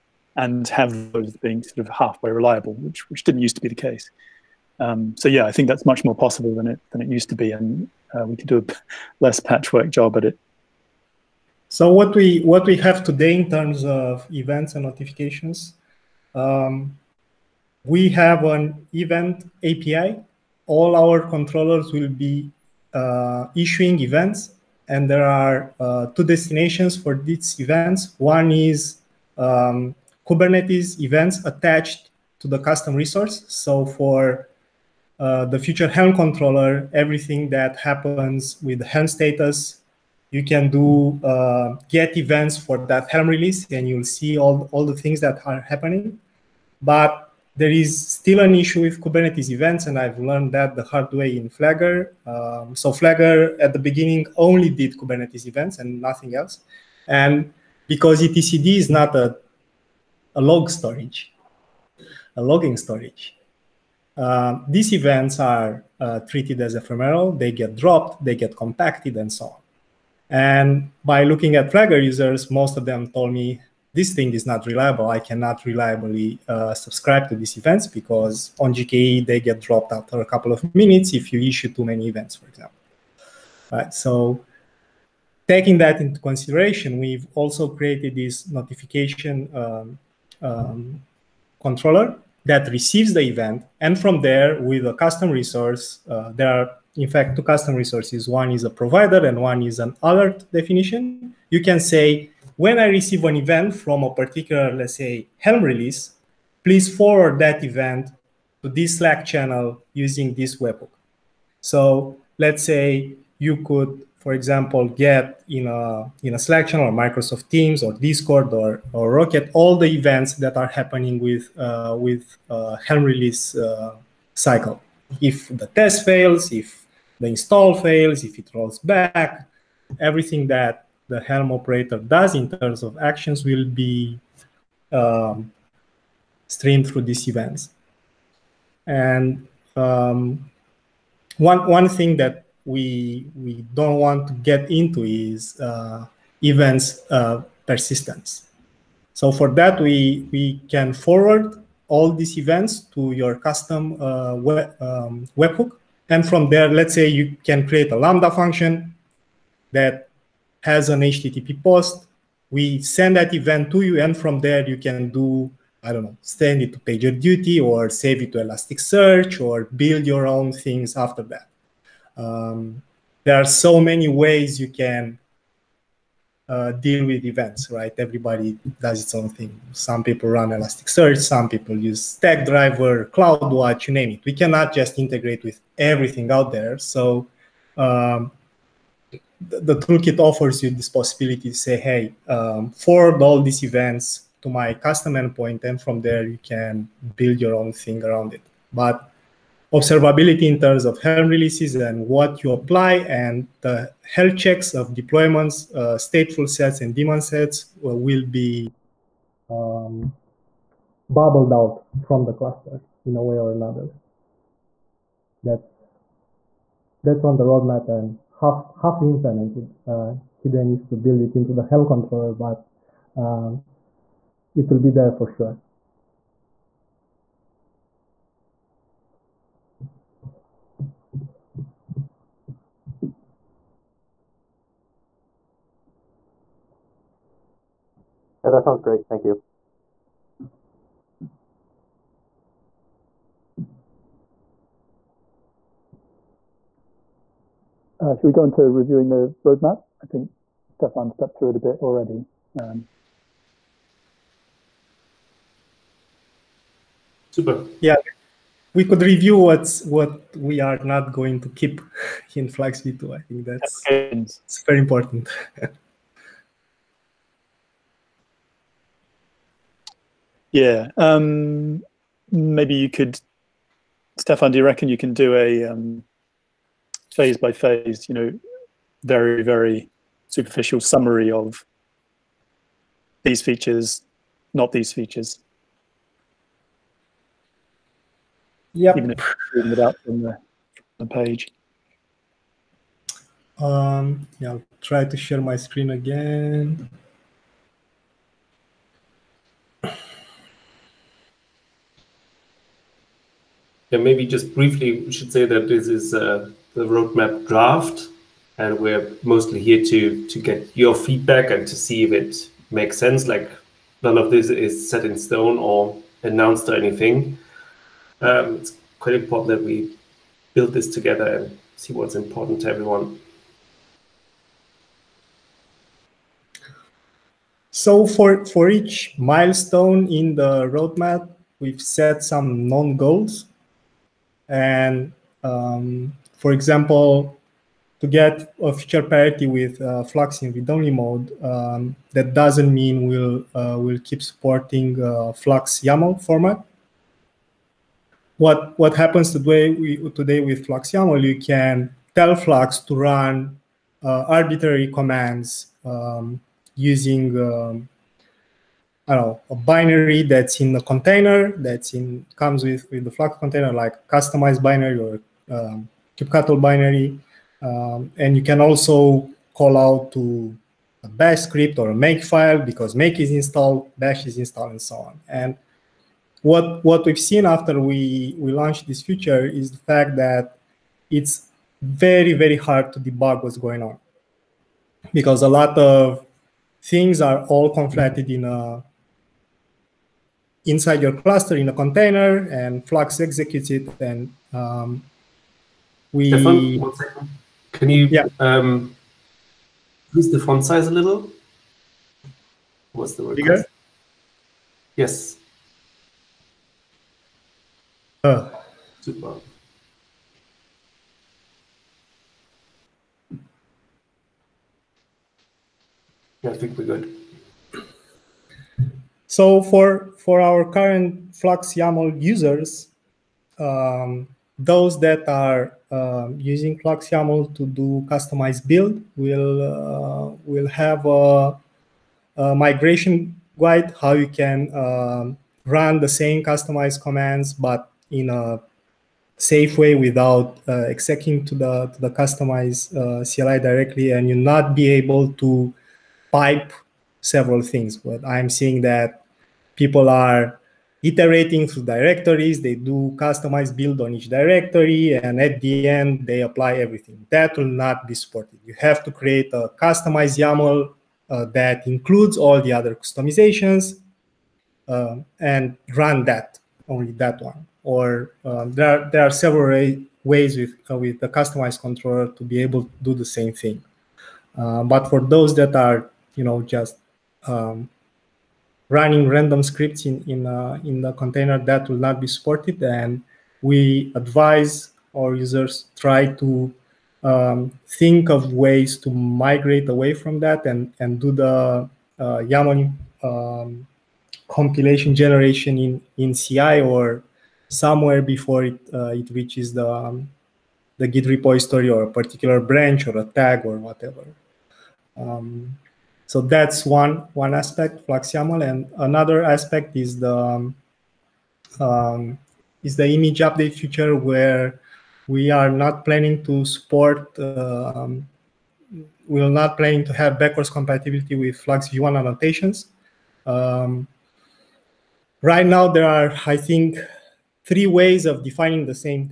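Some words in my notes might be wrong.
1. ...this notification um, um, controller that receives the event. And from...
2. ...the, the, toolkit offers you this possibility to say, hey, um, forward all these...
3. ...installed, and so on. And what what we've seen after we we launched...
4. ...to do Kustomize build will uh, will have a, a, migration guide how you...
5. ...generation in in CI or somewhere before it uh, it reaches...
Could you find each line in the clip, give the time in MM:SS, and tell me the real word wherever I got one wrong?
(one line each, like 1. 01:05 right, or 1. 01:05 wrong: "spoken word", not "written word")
1. 01:28 right
2. 03:09 right
3. 06:14 right
4. 07:07 right
5. 08:15 right.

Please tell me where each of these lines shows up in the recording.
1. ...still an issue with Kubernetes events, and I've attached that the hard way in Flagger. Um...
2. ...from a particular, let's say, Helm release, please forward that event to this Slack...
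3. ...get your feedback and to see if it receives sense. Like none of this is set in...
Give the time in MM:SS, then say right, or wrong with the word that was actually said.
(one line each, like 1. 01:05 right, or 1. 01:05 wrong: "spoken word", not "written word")
1. 00:48 wrong: "learned", not "attached"
2. 01:43 right
3. 05:10 wrong: "makes", not "receives".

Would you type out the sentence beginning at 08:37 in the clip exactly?
Um, we're not planning to have backwards compatibility with Flux V1 annotations.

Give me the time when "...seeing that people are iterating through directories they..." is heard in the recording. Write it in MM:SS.
07:28.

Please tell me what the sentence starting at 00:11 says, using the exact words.
So what we what we have today in terms of events and notifications, um, we have an event API.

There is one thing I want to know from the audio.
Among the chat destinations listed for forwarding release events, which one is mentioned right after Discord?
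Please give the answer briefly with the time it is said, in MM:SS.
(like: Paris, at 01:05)
Rocket, at 01:59.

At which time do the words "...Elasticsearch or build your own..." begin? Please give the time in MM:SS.
02:48.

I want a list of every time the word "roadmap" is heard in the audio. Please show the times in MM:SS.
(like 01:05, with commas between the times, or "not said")
03:37, 04:09, 05:06, 05:30.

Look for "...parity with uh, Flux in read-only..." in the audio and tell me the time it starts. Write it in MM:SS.
05:39.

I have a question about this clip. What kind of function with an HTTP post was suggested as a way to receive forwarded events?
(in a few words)
lambda function.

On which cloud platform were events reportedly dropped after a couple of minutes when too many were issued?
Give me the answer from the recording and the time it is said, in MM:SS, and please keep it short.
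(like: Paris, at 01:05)
GKE, at 01:18.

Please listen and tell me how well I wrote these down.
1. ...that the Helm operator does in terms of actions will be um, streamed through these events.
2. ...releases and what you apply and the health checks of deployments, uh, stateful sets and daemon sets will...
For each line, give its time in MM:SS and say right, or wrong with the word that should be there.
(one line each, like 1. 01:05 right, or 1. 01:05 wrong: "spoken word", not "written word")
1. 02:10 right
2. 03:21 right.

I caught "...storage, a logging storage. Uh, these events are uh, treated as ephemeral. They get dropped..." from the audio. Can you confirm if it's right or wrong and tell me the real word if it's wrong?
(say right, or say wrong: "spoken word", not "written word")
right.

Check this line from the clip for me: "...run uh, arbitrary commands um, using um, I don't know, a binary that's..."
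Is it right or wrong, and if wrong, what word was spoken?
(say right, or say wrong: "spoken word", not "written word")
right.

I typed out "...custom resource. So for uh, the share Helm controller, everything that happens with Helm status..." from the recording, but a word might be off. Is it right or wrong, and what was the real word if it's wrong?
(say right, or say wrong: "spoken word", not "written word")
wrong: "future", not "share".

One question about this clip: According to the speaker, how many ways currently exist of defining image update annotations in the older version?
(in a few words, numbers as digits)
3.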